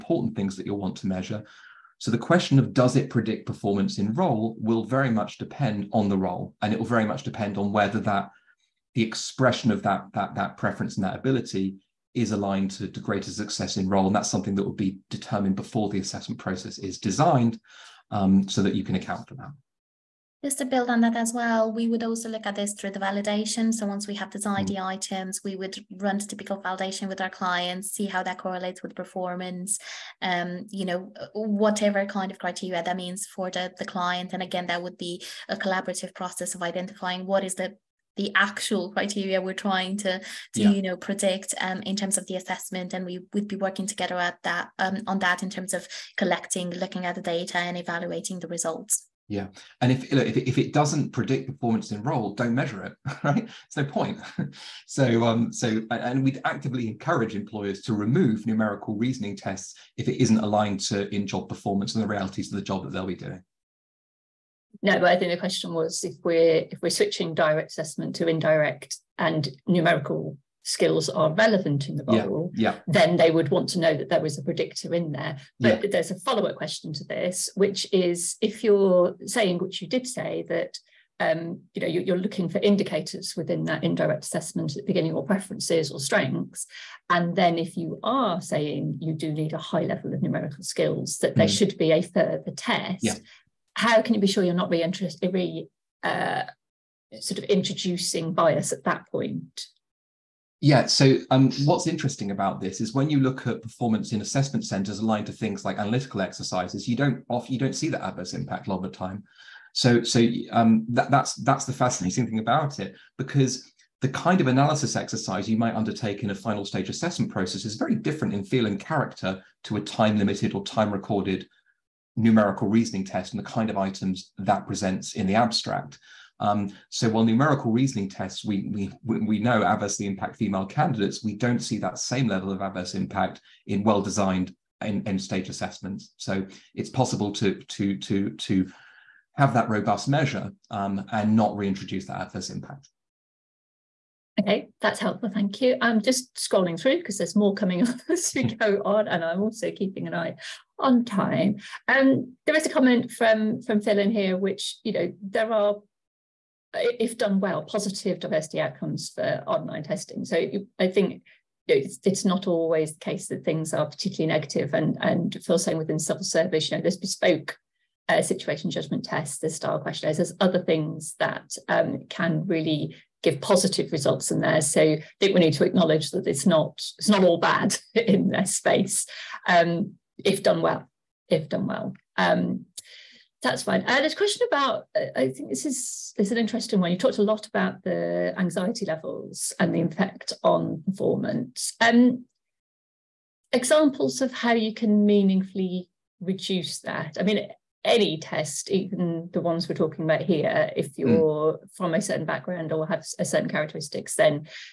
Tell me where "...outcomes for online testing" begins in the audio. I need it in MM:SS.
02:38.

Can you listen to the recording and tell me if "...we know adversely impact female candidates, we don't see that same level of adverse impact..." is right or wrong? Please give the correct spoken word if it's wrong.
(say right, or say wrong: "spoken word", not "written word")
right.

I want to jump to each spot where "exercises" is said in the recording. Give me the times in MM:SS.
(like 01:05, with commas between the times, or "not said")
01:46, 01:54.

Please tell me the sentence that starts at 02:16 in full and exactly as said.
So it's possible to, to, to, to have that robust measure um, and not reintroduce that adverse impact.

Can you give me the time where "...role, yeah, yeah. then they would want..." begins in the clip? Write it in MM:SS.
01:12.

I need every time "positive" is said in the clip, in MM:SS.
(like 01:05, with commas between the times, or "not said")
02:37, 02:53.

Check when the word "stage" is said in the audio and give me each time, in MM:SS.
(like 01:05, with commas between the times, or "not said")
01:56, 02:14.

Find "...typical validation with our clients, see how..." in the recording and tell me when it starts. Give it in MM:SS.
00:26.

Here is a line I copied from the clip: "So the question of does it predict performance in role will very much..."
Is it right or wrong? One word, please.
right.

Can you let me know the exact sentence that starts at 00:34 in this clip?
And again, that would be a collaborative process of identifying what is the the actual criteria we're trying to to yeah.